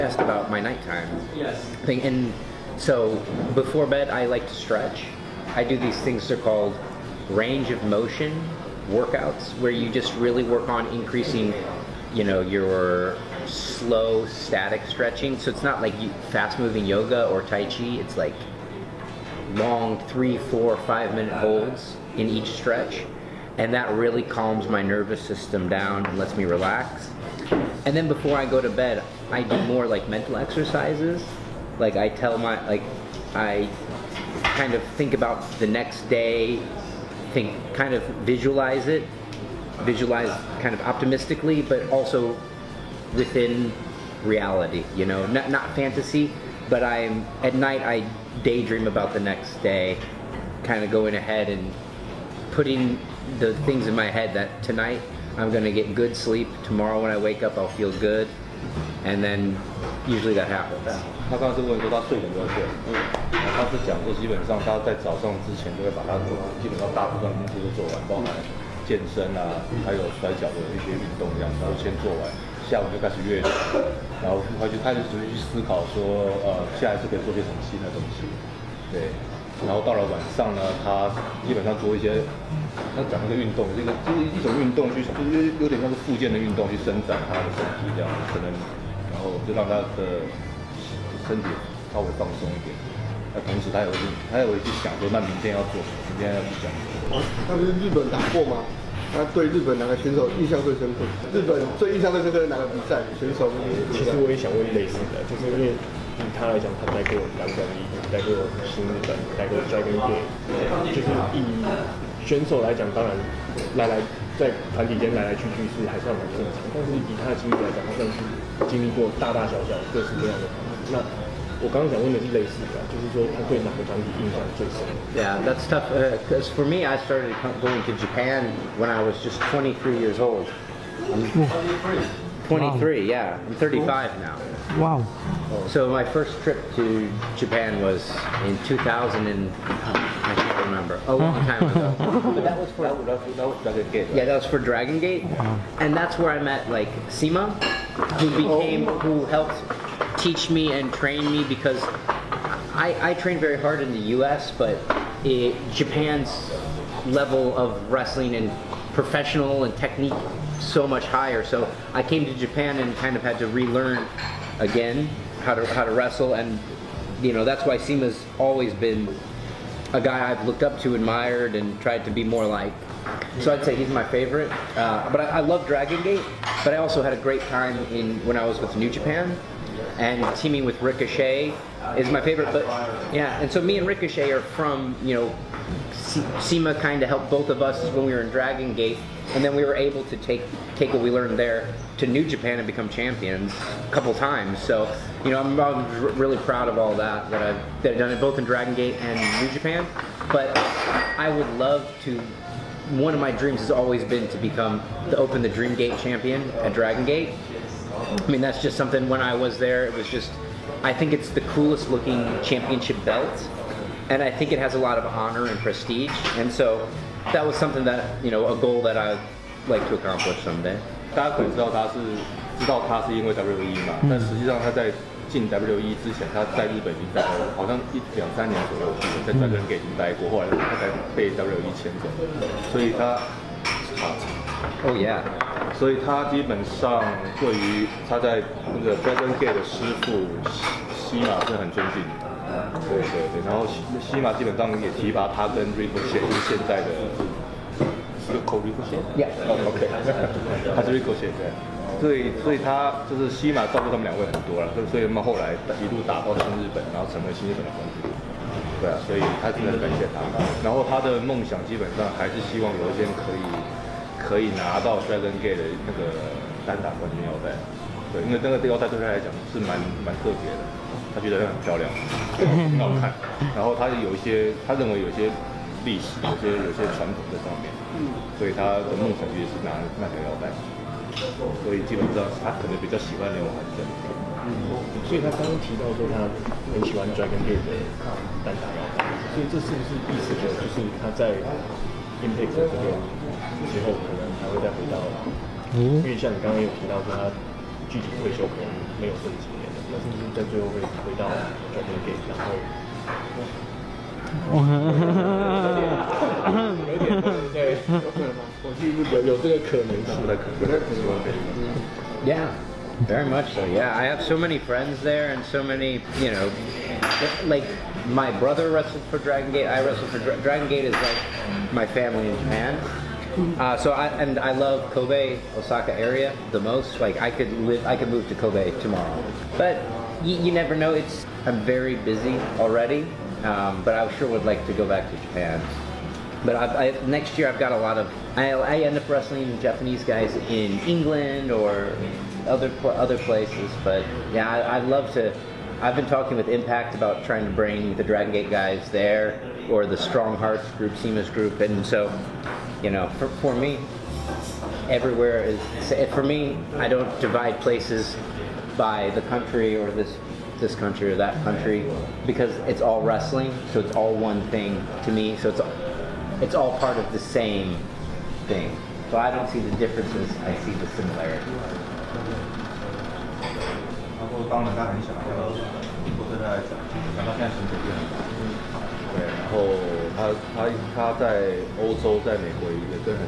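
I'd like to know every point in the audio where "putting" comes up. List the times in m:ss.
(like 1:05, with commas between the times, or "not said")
0:52.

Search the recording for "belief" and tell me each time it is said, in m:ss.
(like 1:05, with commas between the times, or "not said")
not said.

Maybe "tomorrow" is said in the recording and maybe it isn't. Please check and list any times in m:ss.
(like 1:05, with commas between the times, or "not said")
0:56, 5:28.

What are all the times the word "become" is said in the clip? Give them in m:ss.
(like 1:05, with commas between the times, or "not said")
3:12, 3:24.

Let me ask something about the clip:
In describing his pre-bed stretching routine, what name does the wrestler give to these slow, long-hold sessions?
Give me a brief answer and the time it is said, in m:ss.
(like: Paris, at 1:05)
range of motion workouts, at 0:07.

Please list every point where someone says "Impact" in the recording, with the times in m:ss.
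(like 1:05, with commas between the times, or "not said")
4:52, 5:46.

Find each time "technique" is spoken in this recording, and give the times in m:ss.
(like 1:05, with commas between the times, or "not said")
2:39.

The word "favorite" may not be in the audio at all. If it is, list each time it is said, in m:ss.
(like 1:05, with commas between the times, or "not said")
2:54, 3:02.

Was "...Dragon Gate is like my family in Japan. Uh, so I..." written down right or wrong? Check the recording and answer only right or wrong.
right.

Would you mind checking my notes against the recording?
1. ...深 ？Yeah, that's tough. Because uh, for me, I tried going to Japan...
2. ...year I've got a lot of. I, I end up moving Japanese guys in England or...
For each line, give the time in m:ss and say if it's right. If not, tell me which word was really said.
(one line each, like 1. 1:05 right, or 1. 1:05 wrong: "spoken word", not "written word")
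1. 2:04 wrong: "started", not "tried"
2. 5:37 wrong: "wrestling", not "moving".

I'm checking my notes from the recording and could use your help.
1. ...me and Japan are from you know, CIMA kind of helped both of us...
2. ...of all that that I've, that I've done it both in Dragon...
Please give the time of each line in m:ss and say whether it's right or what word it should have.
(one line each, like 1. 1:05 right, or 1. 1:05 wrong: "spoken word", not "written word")
1. 3:03 wrong: "Ricochet", not "Japan"
2. 3:16 right.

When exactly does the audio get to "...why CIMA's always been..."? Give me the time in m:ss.
2:47.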